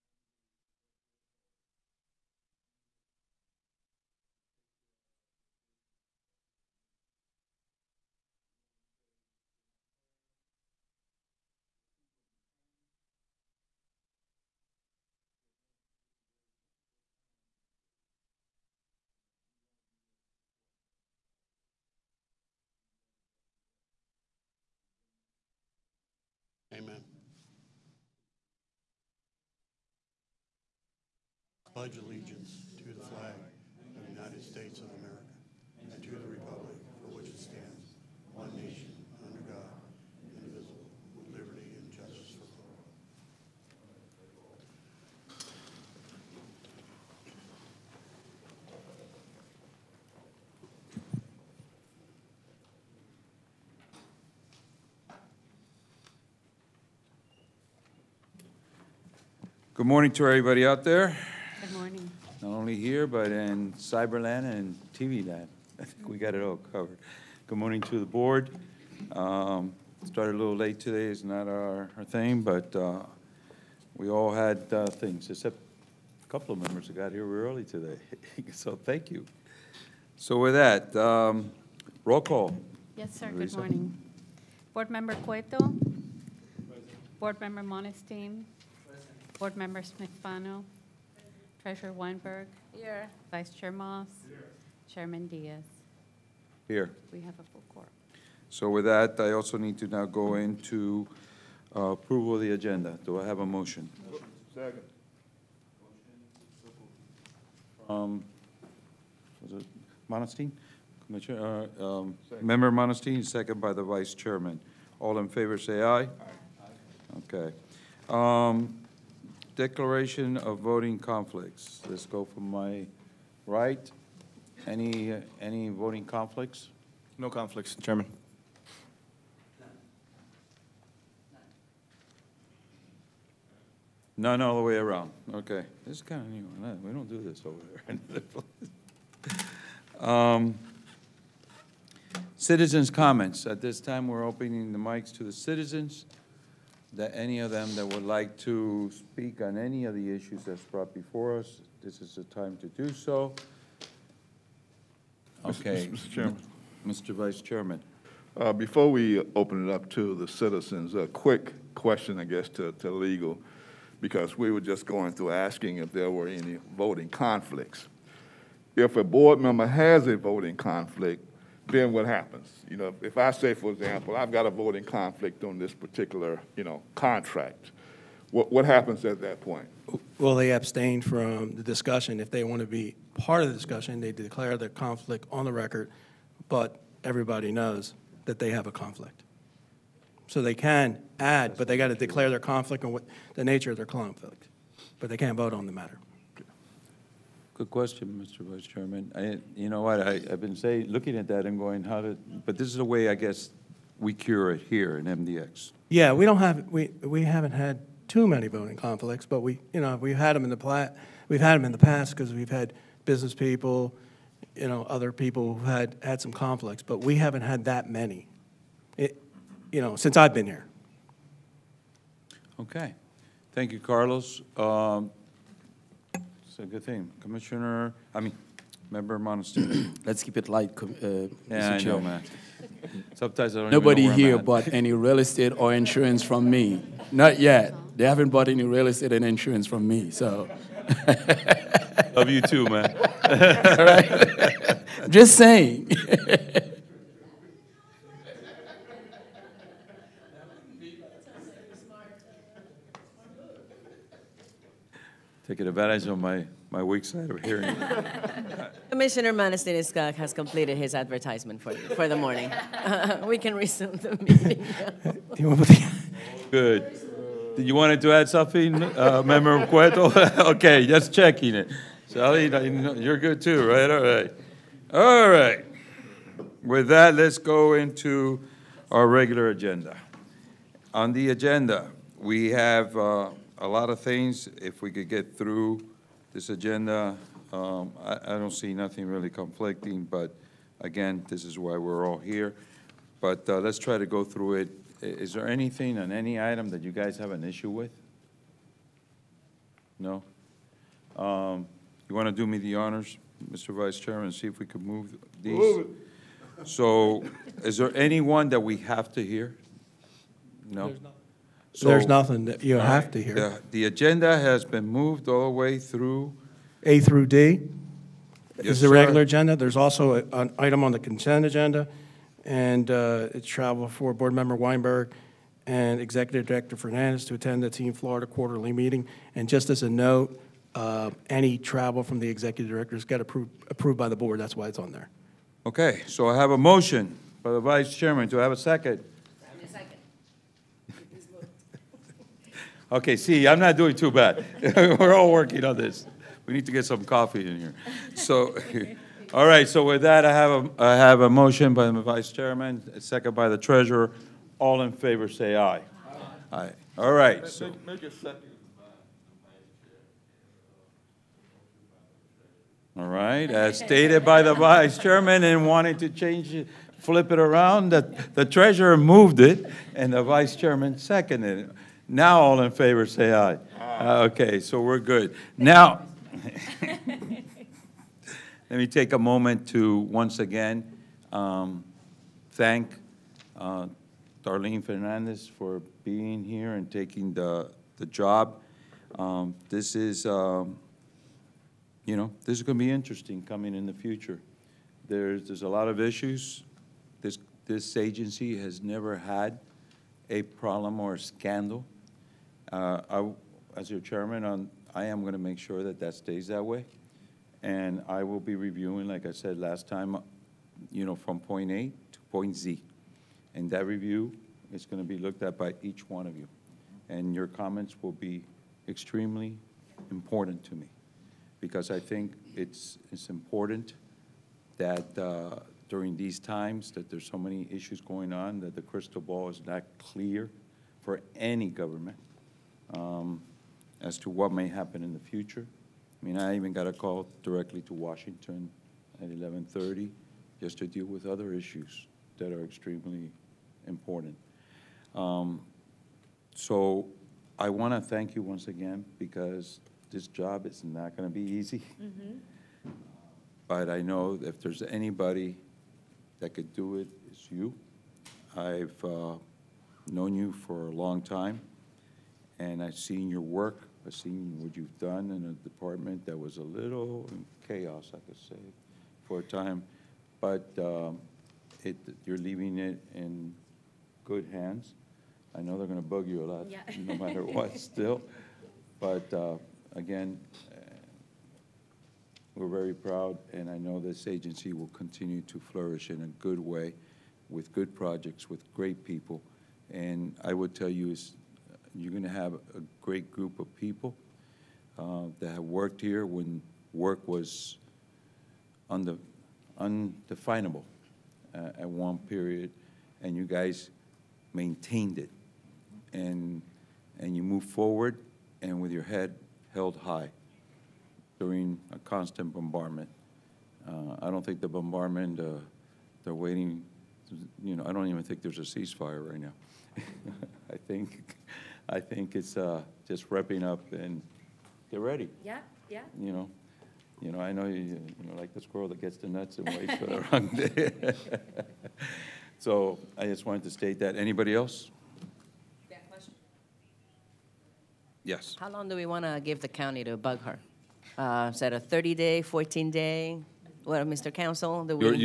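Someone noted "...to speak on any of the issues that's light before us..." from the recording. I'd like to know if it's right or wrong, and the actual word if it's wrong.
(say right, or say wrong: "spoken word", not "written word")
wrong: "brought", not "light".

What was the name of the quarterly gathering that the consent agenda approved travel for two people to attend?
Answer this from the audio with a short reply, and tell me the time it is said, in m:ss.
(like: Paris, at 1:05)
Team Florida, at 5:27.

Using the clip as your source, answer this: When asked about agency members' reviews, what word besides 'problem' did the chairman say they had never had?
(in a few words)
Scandal.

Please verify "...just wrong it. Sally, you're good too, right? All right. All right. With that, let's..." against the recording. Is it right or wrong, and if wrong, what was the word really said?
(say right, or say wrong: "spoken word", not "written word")
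wrong: "checking", not "wrong".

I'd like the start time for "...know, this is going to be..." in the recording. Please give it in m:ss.
6:32.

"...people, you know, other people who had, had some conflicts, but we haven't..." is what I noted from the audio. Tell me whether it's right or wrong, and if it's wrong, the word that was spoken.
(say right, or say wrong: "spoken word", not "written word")
right.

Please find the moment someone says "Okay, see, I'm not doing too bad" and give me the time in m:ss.
5:42.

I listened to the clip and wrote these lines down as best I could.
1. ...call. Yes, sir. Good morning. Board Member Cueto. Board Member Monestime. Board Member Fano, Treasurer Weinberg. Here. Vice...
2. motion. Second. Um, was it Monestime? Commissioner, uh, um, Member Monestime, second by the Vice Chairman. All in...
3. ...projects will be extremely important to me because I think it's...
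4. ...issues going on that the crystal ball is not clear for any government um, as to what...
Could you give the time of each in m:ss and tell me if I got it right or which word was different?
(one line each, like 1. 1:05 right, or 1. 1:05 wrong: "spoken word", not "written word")
1. 1:22 right
2. 1:44 right
3. 6:57 wrong: "comments", not "projects"
4. 7:07 right.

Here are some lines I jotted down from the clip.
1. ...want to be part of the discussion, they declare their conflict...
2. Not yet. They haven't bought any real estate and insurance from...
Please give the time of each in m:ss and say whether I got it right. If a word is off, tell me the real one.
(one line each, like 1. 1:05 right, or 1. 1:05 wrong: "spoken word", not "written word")
1. 3:02 right
2. 3:57 right.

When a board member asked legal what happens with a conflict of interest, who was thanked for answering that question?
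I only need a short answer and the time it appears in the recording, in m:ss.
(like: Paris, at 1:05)
Carlos, at 3:43.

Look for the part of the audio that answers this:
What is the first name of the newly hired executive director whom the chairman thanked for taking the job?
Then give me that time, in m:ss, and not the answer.
6:24.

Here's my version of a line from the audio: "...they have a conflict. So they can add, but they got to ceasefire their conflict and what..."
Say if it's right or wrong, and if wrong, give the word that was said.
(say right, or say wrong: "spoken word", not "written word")
wrong: "declare", not "ceasefire".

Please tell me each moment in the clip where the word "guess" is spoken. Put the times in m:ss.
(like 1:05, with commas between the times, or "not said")
2:42, 3:23.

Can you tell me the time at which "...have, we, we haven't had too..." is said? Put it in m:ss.
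3:26.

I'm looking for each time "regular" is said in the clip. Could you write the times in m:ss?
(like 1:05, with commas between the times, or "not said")
4:39, 5:18.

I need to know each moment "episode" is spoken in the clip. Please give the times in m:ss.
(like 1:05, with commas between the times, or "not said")
not said.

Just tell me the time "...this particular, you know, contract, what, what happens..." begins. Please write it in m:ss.
2:55.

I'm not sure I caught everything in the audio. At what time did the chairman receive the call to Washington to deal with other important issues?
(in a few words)
11:30.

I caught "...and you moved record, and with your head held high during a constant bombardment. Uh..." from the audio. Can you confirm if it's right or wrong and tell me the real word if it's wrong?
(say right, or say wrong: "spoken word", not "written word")
wrong: "forward", not "record".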